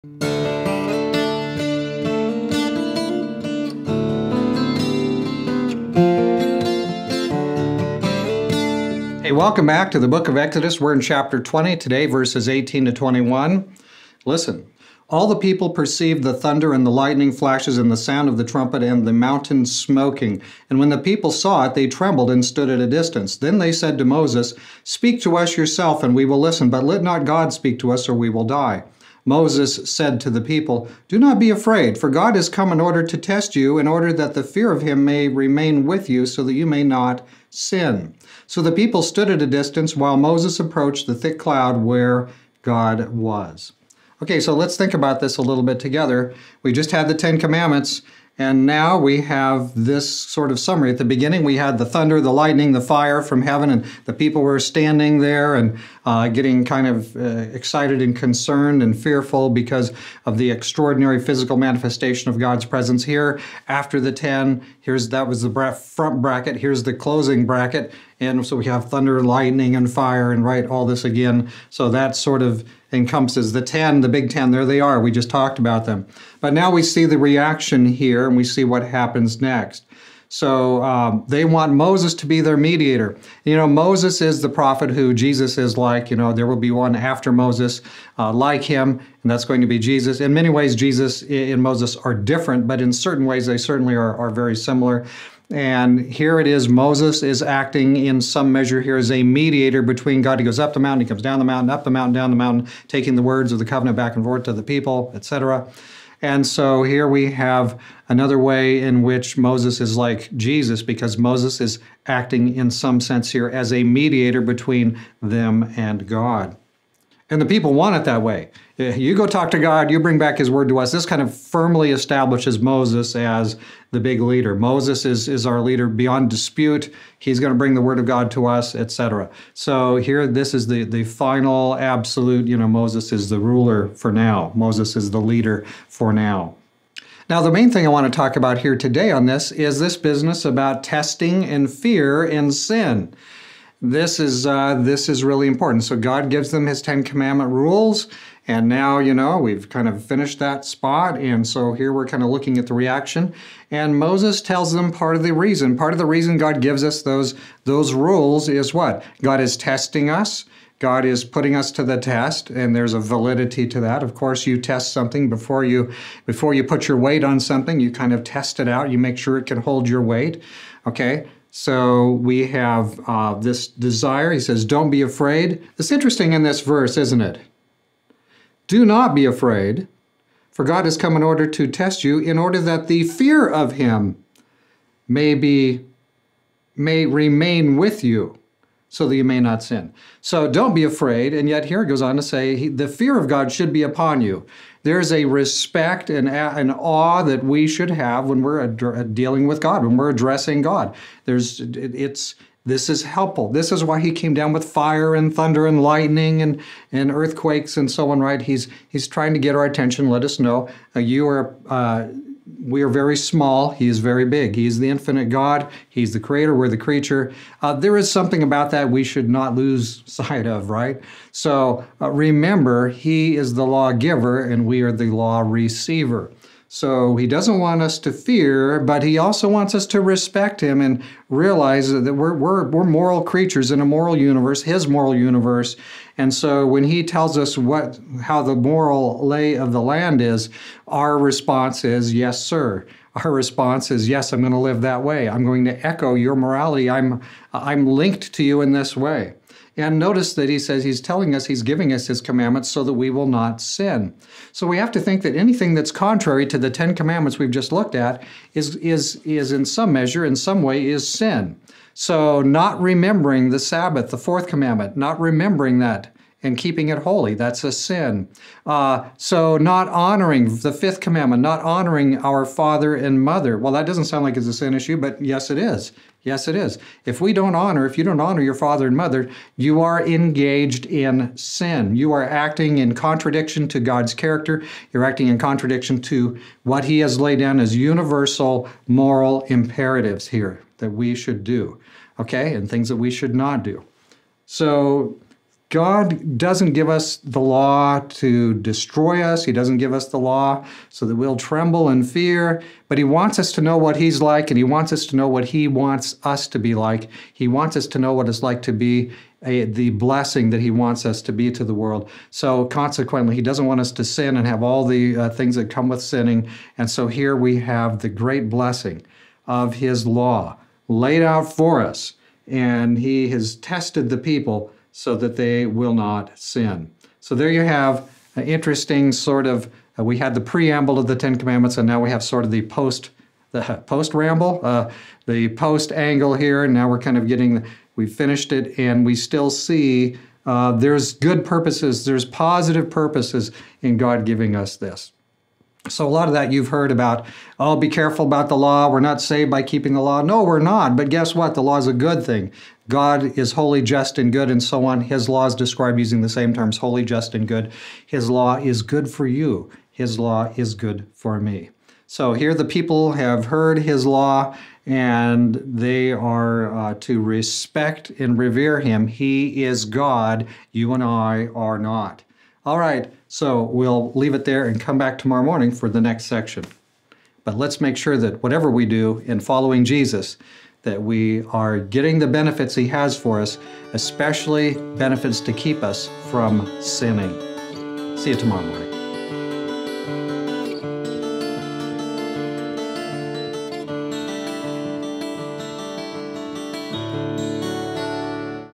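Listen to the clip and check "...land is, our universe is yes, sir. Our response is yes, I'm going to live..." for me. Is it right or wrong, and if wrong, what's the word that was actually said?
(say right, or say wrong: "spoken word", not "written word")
wrong: "response", not "universe".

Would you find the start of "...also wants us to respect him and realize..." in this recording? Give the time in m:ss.
3:49.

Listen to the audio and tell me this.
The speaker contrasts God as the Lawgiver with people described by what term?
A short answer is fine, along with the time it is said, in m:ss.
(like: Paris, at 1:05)
law receiver, at 3:45.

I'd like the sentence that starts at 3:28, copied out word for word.
He's, he's trying to get our attention, let us know uh, you are uh, we are very small.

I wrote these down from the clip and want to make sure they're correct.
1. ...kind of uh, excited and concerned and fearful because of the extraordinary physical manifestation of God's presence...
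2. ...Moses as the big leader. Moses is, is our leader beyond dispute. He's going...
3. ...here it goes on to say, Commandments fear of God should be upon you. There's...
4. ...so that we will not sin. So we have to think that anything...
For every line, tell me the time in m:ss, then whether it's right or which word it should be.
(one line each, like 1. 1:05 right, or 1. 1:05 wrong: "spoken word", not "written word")
1. 0:56 right
2. 2:02 right
3. 3:11 wrong: "The", not "Commandments"
4. 4:12 right.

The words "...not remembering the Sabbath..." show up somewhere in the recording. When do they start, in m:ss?
4:22.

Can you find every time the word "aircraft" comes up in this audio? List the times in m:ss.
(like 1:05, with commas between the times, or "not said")
not said.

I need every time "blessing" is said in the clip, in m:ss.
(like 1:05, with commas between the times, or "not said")
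5:09, 5:18.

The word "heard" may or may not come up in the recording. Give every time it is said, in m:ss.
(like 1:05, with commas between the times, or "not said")
5:46, 6:03.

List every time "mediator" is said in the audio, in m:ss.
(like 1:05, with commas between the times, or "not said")
1:22, 1:39, 1:53.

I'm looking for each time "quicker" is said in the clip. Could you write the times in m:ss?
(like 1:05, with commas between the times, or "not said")
not said.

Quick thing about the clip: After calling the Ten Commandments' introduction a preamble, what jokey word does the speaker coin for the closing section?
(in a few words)
post ramble.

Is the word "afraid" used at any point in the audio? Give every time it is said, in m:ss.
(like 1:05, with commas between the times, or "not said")
0:31, 2:55, 2:59, 3:10.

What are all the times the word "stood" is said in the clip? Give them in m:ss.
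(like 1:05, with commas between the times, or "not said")
0:22, 0:39.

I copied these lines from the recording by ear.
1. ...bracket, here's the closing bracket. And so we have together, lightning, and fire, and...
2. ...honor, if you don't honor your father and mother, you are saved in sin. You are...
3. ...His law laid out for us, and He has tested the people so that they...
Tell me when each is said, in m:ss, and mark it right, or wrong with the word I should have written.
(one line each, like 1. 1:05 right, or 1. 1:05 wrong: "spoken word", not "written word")
1. 1:06 wrong: "thunder", not "together"
2. 4:37 wrong: "engaged", not "saved"
3. 5:19 right.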